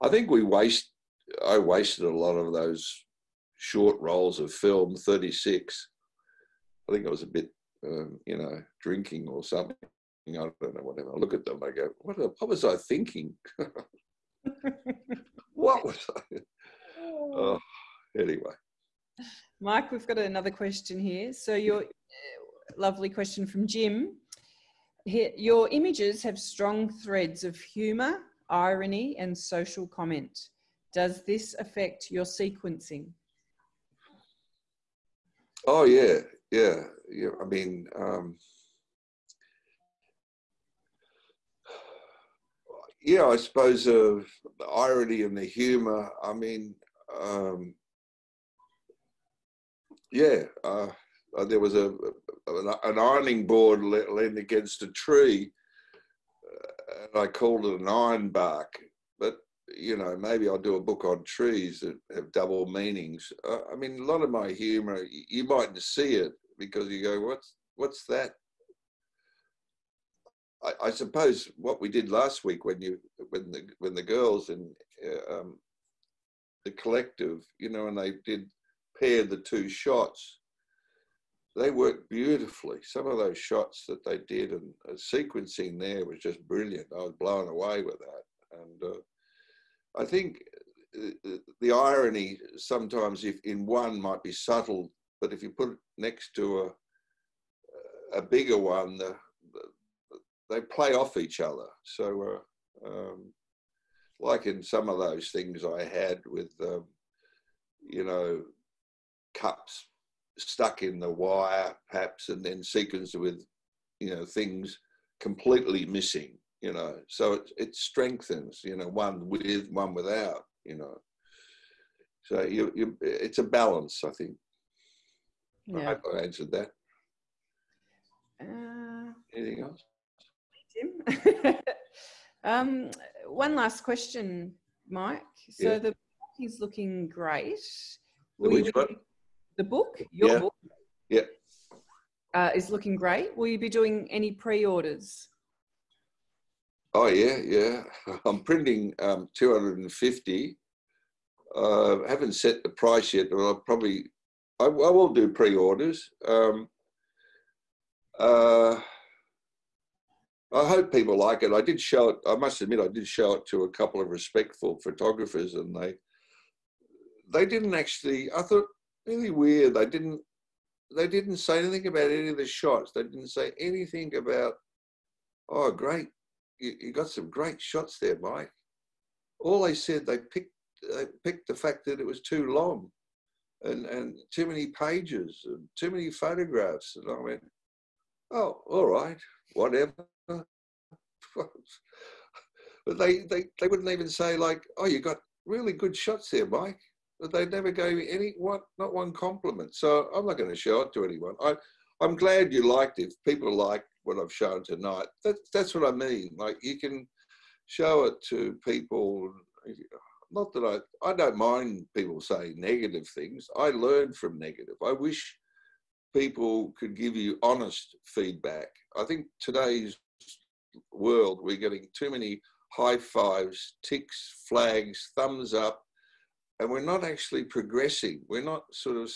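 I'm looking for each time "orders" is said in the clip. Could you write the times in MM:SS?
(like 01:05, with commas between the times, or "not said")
02:24, 02:35.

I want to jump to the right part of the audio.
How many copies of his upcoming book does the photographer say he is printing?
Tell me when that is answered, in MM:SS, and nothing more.
02:29.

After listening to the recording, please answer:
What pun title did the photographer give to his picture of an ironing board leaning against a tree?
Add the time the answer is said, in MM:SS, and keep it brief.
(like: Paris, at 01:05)
iron bark, at 00:57.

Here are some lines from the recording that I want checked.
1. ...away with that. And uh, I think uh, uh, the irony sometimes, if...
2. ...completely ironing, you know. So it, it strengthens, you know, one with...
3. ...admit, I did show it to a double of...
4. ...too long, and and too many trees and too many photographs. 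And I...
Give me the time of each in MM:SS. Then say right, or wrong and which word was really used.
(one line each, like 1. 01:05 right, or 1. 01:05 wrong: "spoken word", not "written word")
1. 01:27 right
2. 01:55 wrong: "missing", not "ironing"
3. 02:42 wrong: "couple", not "double"
4. 03:02 wrong: "pages", not "trees".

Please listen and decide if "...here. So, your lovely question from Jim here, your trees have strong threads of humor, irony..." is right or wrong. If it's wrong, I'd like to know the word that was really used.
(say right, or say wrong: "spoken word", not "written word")
wrong: "images", not "trees".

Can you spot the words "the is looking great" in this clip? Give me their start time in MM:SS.
02:15.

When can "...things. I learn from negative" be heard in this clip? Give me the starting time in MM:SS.
03:33.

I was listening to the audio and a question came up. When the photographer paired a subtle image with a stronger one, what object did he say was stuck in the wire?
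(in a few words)
cups.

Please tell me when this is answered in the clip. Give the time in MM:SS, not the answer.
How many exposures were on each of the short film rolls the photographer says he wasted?
00:04.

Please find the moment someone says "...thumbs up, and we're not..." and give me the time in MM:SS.
03:45.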